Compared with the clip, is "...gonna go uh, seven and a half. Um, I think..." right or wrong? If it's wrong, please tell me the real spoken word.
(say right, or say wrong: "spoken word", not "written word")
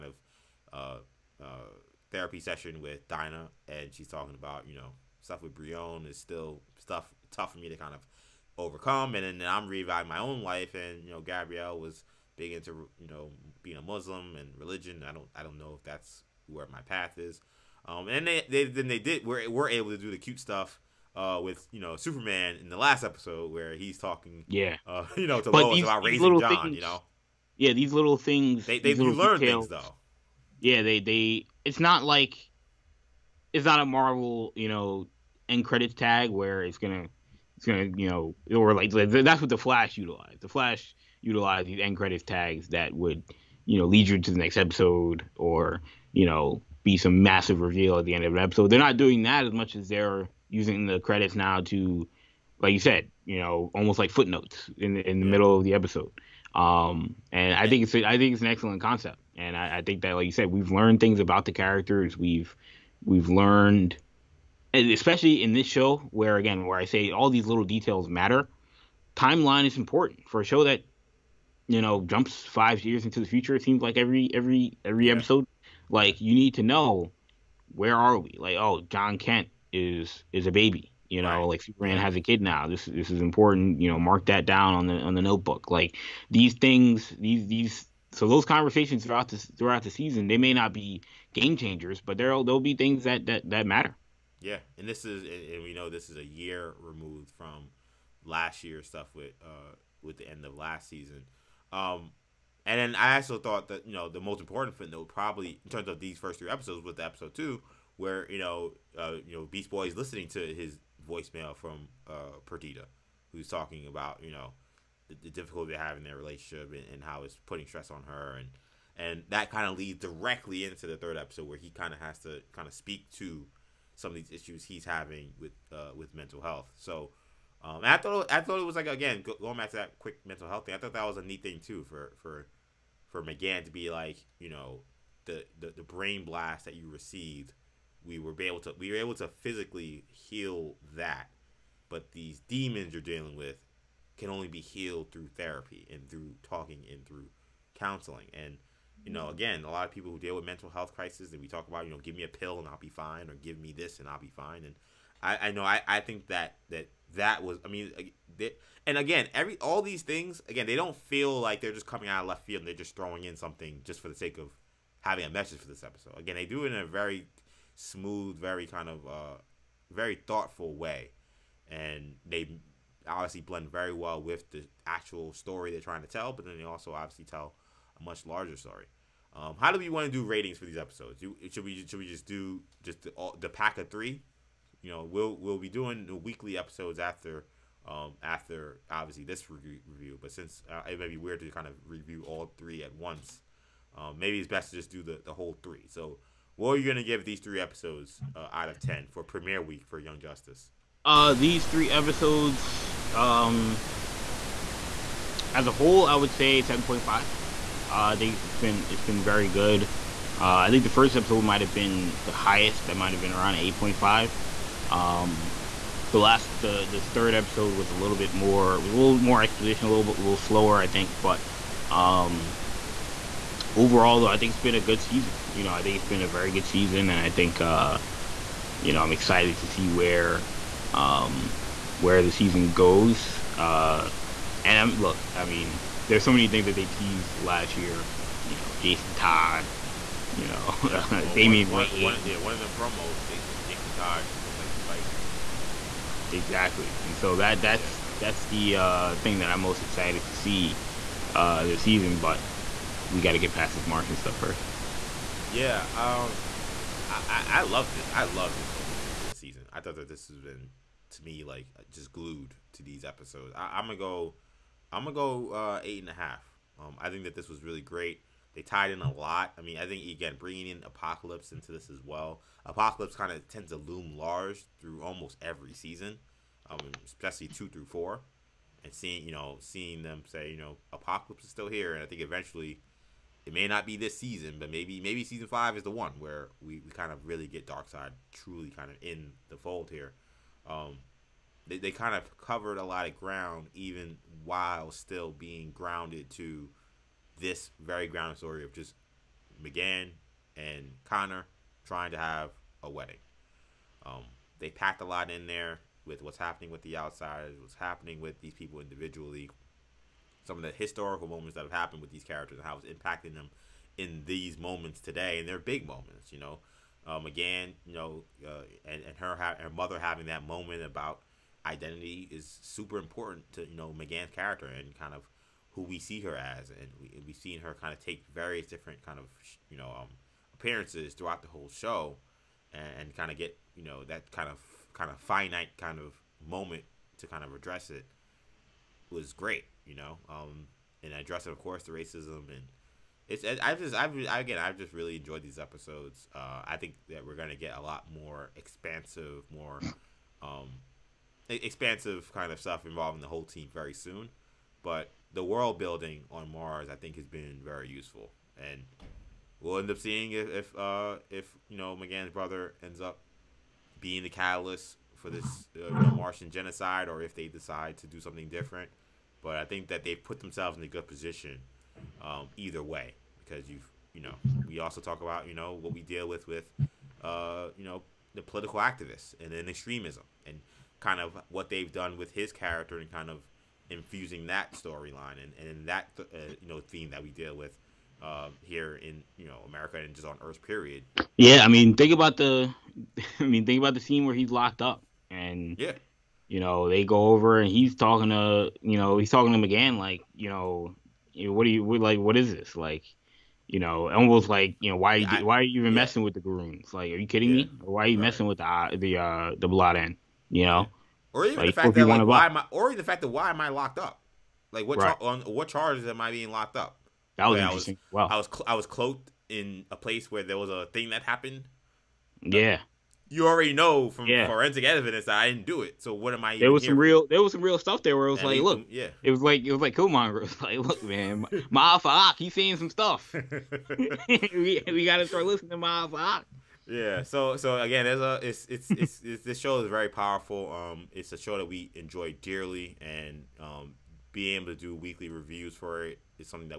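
wrong: "eight", not "seven".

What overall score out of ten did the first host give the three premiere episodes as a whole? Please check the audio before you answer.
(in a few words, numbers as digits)
7.5.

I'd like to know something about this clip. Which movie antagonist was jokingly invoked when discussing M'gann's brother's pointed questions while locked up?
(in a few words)
Killmonger.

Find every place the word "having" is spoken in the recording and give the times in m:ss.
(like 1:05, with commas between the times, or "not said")
2:04, 2:44, 5:19.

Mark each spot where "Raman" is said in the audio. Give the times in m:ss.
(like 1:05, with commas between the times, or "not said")
not said.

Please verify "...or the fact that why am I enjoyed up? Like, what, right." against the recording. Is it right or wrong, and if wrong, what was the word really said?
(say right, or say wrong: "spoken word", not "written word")
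wrong: "locked", not "enjoyed".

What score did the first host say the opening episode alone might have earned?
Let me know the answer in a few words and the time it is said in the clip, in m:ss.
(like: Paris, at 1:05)
8.5, at 3:33.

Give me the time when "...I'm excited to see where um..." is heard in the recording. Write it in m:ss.
3:49.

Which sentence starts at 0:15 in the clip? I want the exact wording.
I don't I don't know if that's where my path is.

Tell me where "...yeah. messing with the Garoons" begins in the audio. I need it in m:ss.
6:45.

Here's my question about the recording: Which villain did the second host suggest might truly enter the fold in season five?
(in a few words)
Darkseid.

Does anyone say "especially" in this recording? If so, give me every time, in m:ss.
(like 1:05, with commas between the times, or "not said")
1:04, 4:37.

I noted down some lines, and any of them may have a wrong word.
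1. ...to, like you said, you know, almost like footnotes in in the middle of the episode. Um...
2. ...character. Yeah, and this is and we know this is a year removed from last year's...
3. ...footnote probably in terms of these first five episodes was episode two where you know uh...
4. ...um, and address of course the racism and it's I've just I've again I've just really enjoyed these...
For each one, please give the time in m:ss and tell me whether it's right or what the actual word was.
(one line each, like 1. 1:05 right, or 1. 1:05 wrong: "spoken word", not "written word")
1. 0:51 right
2. 1:33 wrong: "matter", not "character"
3. 1:44 wrong: "three", not "five"
4. 5:40 right.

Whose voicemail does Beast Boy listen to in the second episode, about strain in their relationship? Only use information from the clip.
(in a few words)
Perdita.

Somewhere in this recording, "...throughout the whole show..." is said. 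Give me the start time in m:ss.
5:31.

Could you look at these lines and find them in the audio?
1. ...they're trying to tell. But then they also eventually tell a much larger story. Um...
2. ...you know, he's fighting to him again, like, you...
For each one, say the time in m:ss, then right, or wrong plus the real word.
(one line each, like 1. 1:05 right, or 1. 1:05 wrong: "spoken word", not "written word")
1. 2:55 wrong: "obviously", not "eventually"
2. 6:38 wrong: "talking", not "fighting".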